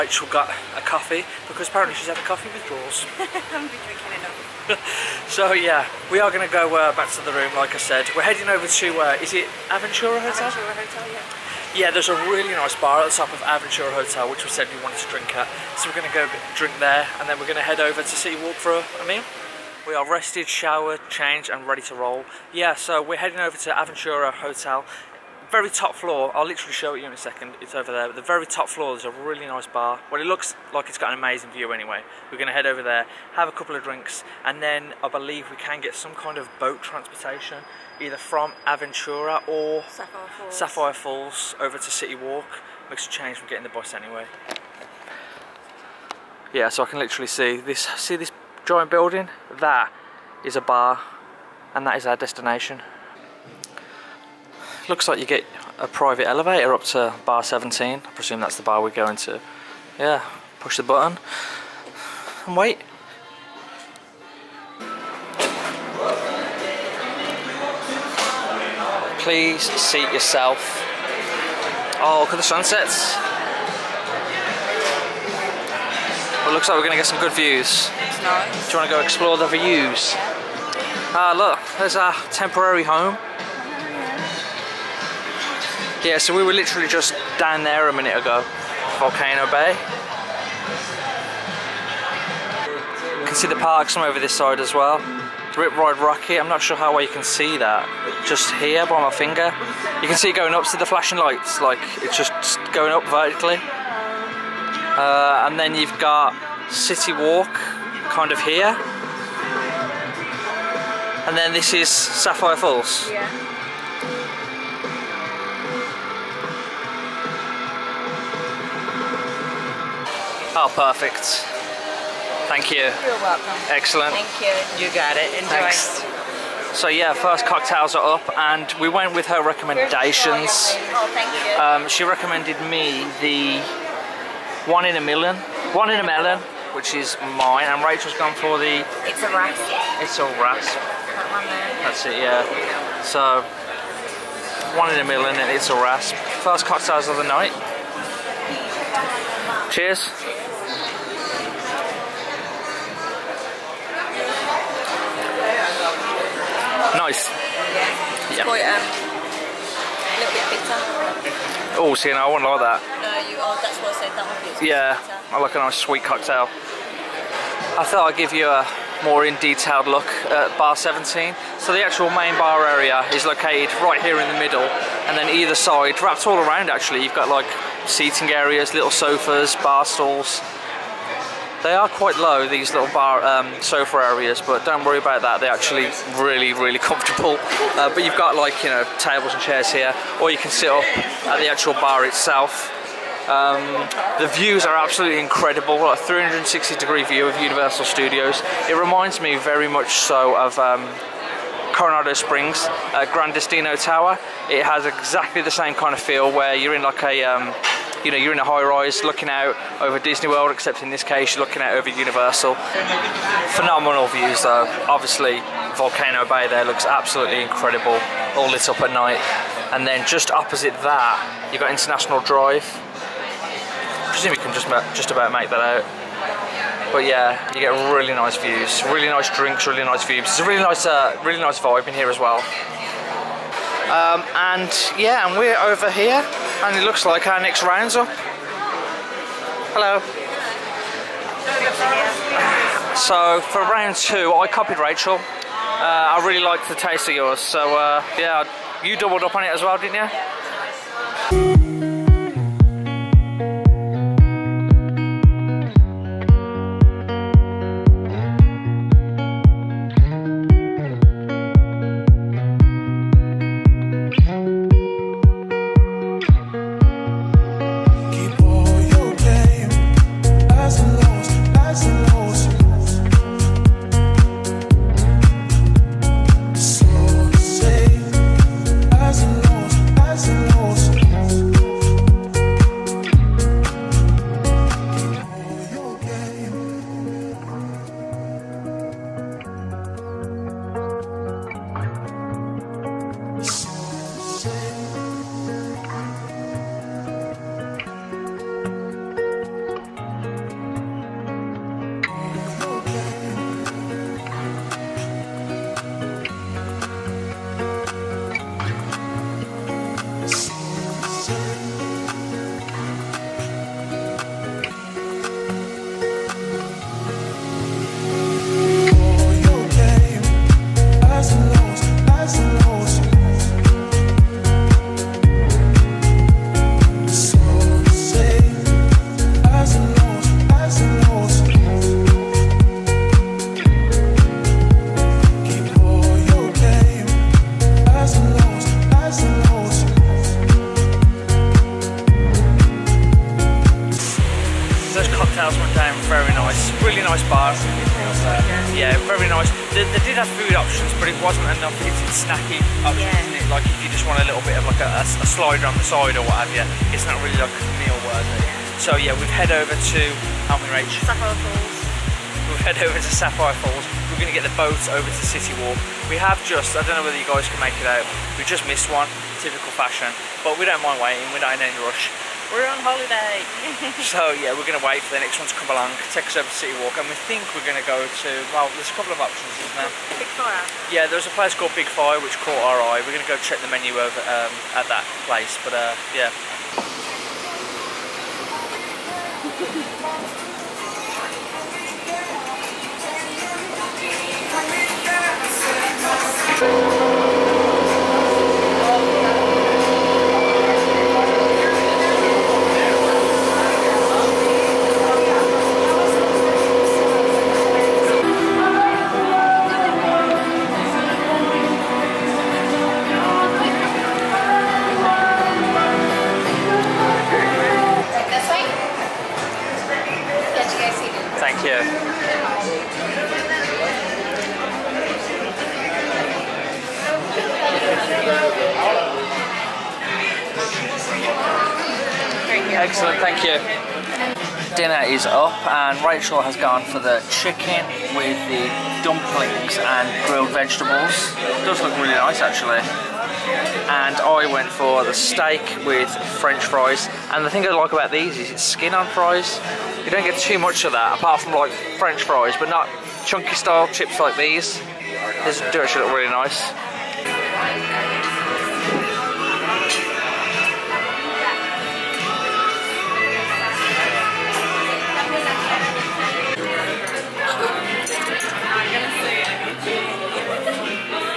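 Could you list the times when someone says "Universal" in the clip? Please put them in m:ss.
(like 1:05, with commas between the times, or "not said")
3:17, 3:31.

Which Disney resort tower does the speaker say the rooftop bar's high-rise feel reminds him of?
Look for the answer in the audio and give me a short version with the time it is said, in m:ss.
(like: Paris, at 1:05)
Gran Destino Tower, at 3:23.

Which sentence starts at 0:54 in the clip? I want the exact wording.
Looks like you get a private elevator up to bar 17.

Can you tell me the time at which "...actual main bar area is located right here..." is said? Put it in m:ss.
2:51.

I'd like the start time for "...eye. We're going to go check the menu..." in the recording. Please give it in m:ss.
6:22.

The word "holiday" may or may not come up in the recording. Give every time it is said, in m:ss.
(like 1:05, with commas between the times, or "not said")
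6:12.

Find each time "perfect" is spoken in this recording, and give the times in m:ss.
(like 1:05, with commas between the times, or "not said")
2:00.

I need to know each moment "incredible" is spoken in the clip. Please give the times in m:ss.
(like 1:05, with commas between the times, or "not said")
3:15, 3:37.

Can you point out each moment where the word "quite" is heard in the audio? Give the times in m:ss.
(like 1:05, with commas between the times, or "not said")
2:38, 3:01.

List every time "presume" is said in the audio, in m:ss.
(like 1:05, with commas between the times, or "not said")
0:58, 3:44.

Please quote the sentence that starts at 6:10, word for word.
But we don't mind waiting, we're not in any rush.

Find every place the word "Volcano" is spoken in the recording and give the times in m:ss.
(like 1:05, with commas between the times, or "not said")
1:29, 3:35.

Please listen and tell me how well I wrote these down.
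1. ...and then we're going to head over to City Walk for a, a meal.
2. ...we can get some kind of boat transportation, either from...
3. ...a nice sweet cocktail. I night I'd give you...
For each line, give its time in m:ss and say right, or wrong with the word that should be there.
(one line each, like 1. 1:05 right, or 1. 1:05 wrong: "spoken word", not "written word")
1. 0:17 right
2. 0:35 right
3. 2:45 wrong: "thought", not "night".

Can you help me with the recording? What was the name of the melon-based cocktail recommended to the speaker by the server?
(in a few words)
One in a Melon.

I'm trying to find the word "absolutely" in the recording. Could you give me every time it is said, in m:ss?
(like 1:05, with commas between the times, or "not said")
3:14, 3:36.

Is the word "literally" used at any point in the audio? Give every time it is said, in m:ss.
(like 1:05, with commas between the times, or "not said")
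0:26, 0:47, 1:26.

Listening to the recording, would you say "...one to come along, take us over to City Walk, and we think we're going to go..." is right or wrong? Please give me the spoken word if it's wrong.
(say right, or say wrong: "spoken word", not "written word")
right.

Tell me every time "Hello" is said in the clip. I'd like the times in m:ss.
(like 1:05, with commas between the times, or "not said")
3:59.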